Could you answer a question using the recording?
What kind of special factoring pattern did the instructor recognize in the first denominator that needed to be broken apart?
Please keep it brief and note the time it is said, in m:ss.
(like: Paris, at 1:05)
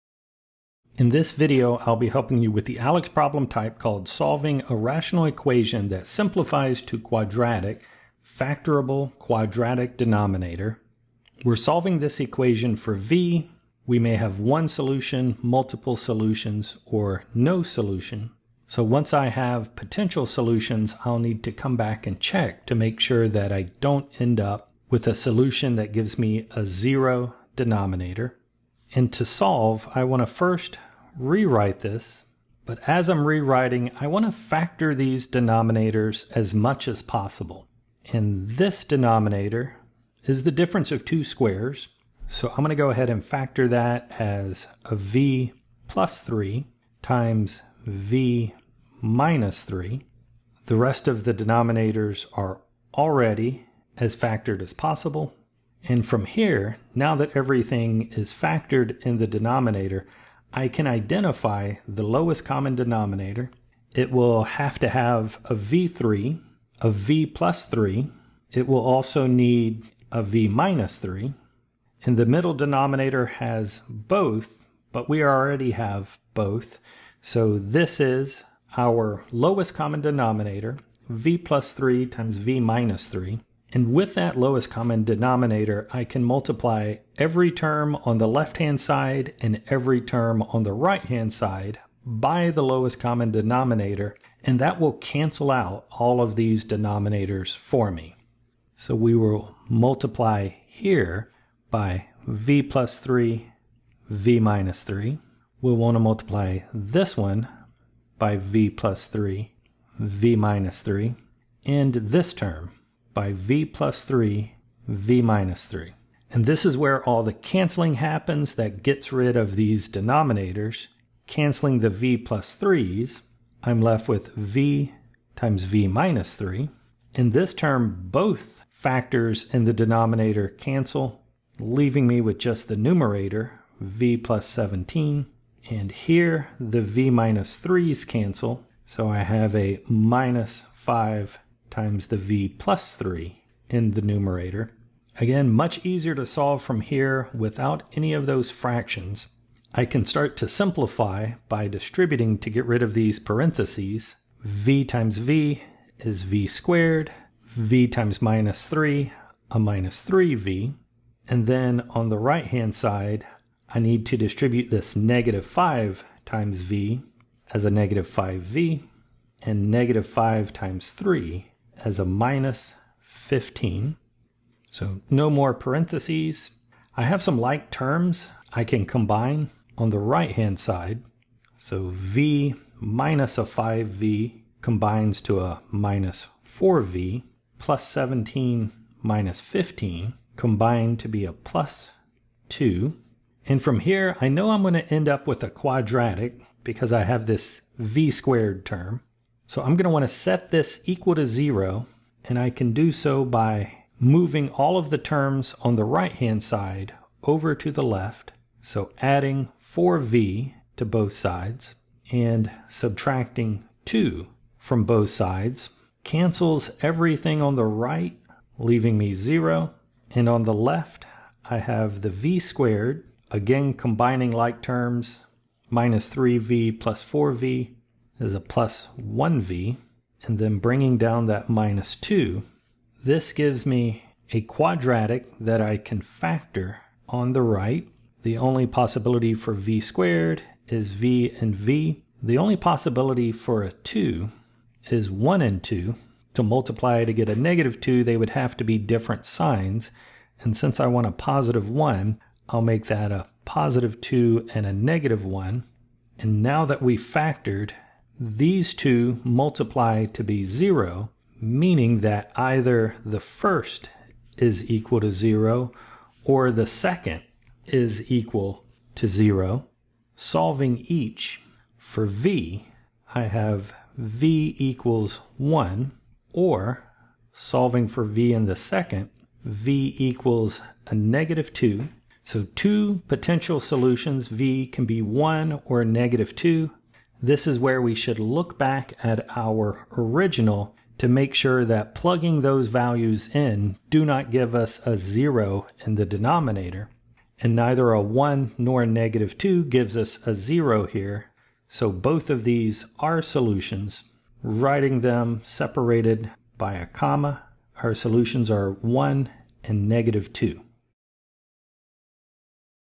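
difference of two squares, at 0:40.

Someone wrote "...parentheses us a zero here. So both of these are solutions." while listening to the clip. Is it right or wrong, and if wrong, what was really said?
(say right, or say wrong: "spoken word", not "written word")
wrong: "gives", not "parentheses".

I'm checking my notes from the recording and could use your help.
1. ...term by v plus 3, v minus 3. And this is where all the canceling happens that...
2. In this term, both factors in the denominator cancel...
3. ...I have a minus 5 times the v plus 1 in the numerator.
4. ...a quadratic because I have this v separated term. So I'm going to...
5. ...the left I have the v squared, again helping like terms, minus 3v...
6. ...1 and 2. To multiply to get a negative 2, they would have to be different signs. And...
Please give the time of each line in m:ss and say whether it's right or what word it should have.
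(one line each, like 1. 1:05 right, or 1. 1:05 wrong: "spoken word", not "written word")
1. 1:52 right
2. 2:07 right
3. 2:19 wrong: "3", not "1"
4. 3:15 wrong: "squared", not "separated"
5. 3:40 wrong: "combining", not "helping"
6. 4:05 right.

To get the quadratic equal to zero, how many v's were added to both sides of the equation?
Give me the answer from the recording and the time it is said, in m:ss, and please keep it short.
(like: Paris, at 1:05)
4v, at 3:28.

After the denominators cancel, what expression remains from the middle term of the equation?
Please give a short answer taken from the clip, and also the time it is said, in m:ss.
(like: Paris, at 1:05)
v + 17, at 2:13.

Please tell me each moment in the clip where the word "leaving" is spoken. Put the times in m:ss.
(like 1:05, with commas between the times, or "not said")
2:11, 3:38.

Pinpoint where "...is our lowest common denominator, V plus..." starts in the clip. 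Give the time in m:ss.
1:18.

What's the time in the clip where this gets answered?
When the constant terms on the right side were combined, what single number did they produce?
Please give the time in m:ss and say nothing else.
3:11.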